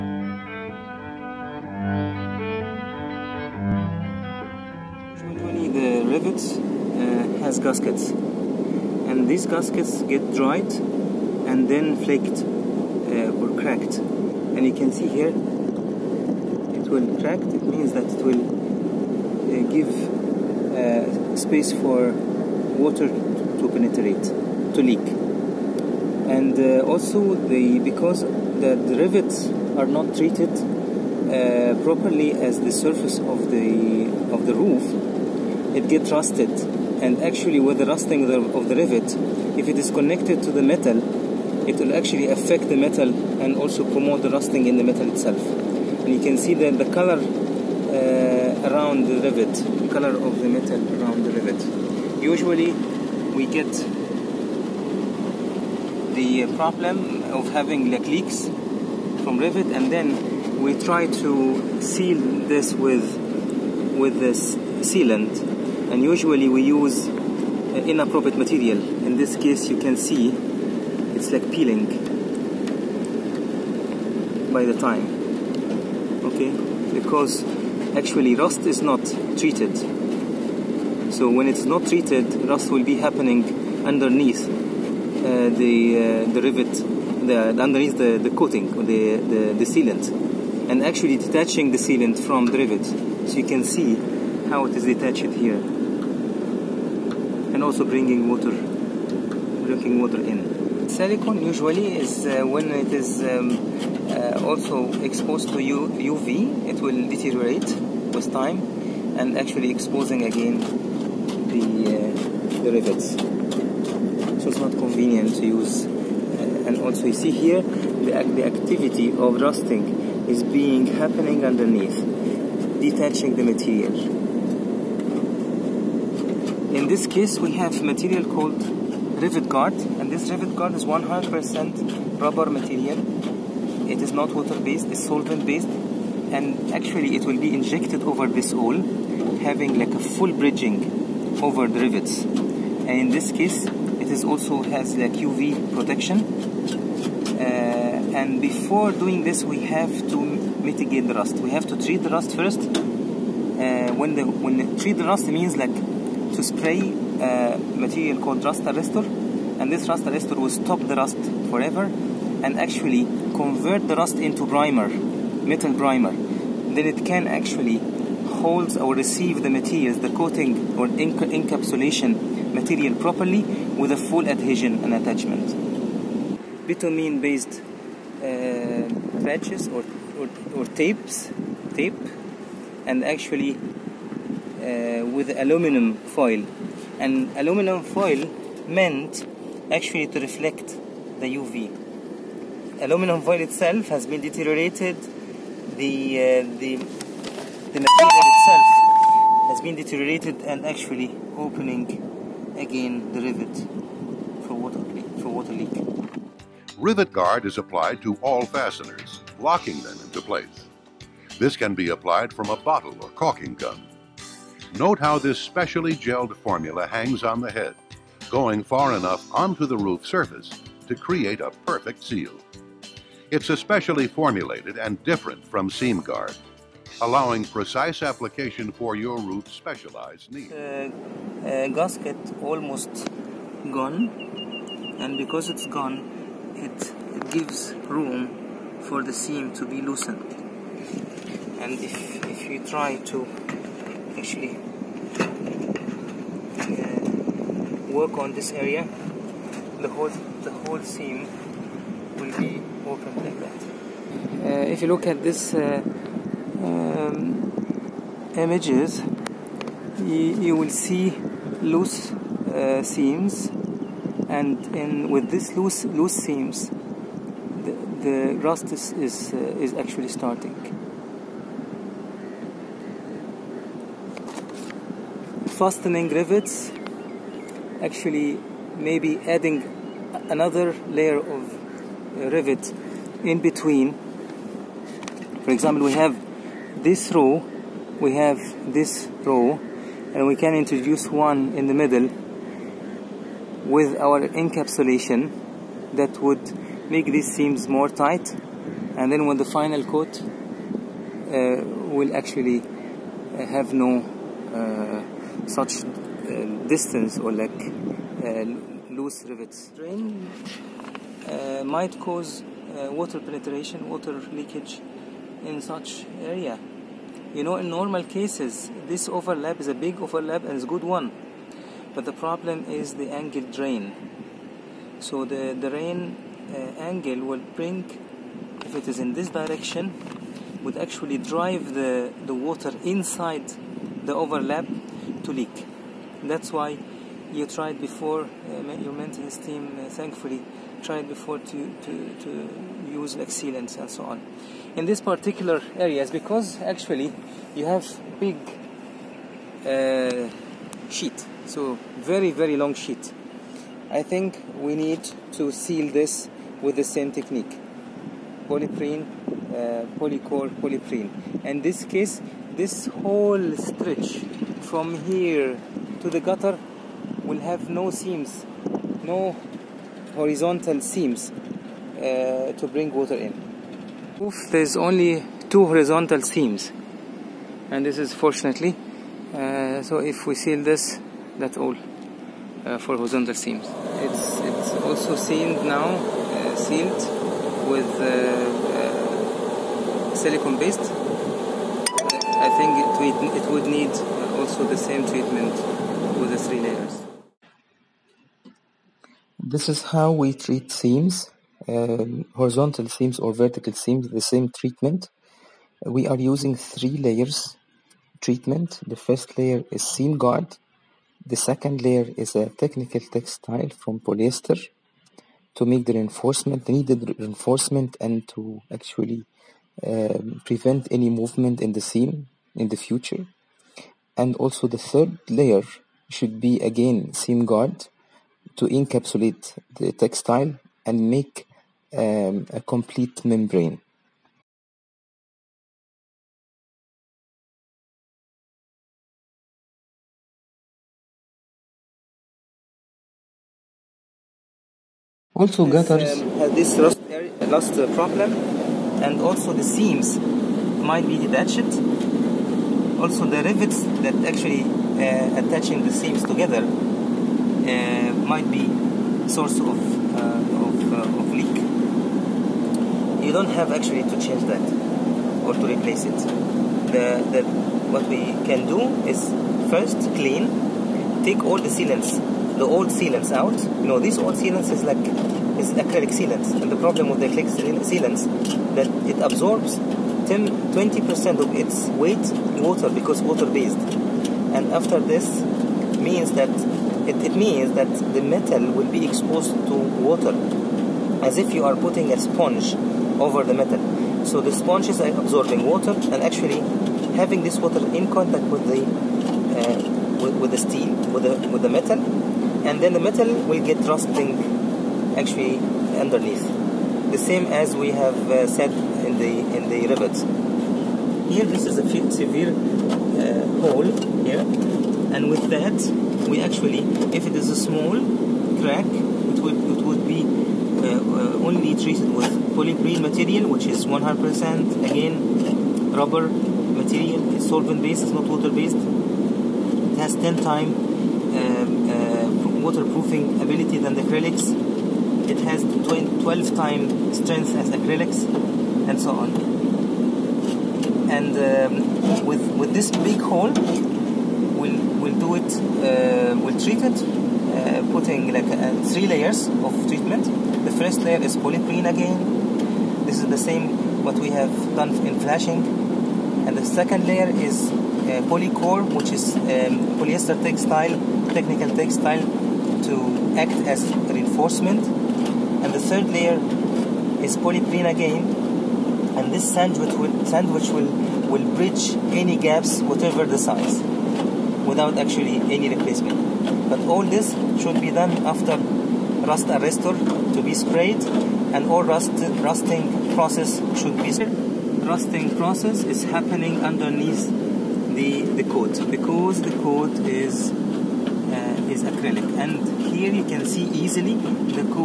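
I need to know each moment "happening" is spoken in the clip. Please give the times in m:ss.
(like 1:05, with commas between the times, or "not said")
1:22, 2:00, 9:46.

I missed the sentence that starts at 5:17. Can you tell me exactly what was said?
You know, in normal cases, this overlap is a big overlap and it's a good one.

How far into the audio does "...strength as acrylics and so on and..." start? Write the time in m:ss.
8:57.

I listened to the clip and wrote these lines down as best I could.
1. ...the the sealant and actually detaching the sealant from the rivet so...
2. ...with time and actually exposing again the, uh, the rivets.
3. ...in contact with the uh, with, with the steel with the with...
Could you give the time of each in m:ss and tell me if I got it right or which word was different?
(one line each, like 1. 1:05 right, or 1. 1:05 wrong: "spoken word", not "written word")
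1. 1:29 right
2. 1:48 right
3. 8:17 right.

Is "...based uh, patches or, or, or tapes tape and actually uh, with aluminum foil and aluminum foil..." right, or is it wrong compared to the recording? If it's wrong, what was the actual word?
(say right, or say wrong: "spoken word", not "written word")
right.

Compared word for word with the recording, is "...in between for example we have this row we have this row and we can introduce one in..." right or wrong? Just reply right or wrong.
right.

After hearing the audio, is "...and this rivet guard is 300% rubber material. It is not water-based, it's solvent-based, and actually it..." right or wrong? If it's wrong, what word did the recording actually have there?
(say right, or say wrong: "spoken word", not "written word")
wrong: "100", not "300".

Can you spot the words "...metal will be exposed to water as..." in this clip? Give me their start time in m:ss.
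8:08.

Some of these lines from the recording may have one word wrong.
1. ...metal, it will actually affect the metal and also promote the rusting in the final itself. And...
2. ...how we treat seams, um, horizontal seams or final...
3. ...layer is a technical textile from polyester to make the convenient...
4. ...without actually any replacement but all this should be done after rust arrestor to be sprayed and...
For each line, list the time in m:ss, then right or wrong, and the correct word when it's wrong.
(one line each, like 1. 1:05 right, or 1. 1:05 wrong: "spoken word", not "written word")
1. 0:40 wrong: "metal", not "final"
2. 6:39 wrong: "vertical", not "final"
3. 6:51 wrong: "reinforcement", not "convenient"
4. 9:34 right.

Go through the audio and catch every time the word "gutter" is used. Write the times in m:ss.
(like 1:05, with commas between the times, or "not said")
6:06, 7:25.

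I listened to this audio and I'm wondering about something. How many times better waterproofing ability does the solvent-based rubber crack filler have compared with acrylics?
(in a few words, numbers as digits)
10 times.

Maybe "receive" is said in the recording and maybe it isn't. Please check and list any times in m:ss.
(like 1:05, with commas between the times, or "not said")
2:48.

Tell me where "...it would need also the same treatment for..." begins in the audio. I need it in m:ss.
6:33.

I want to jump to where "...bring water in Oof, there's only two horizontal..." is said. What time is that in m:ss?
6:12.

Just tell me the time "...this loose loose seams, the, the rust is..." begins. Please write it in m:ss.
4:25.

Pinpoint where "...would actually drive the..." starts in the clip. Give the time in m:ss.
5:30.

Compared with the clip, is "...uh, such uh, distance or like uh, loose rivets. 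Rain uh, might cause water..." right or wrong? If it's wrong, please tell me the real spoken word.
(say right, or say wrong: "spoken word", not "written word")
right.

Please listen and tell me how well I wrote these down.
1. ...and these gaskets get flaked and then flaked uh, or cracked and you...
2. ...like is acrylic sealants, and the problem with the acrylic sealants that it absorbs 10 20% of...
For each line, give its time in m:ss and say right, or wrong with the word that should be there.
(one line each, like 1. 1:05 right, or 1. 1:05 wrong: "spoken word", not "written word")
1. 0:08 wrong: "dried", not "flaked"
2. 7:54 right.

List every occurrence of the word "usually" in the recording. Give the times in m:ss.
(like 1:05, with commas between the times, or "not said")
0:52, 1:06, 1:41.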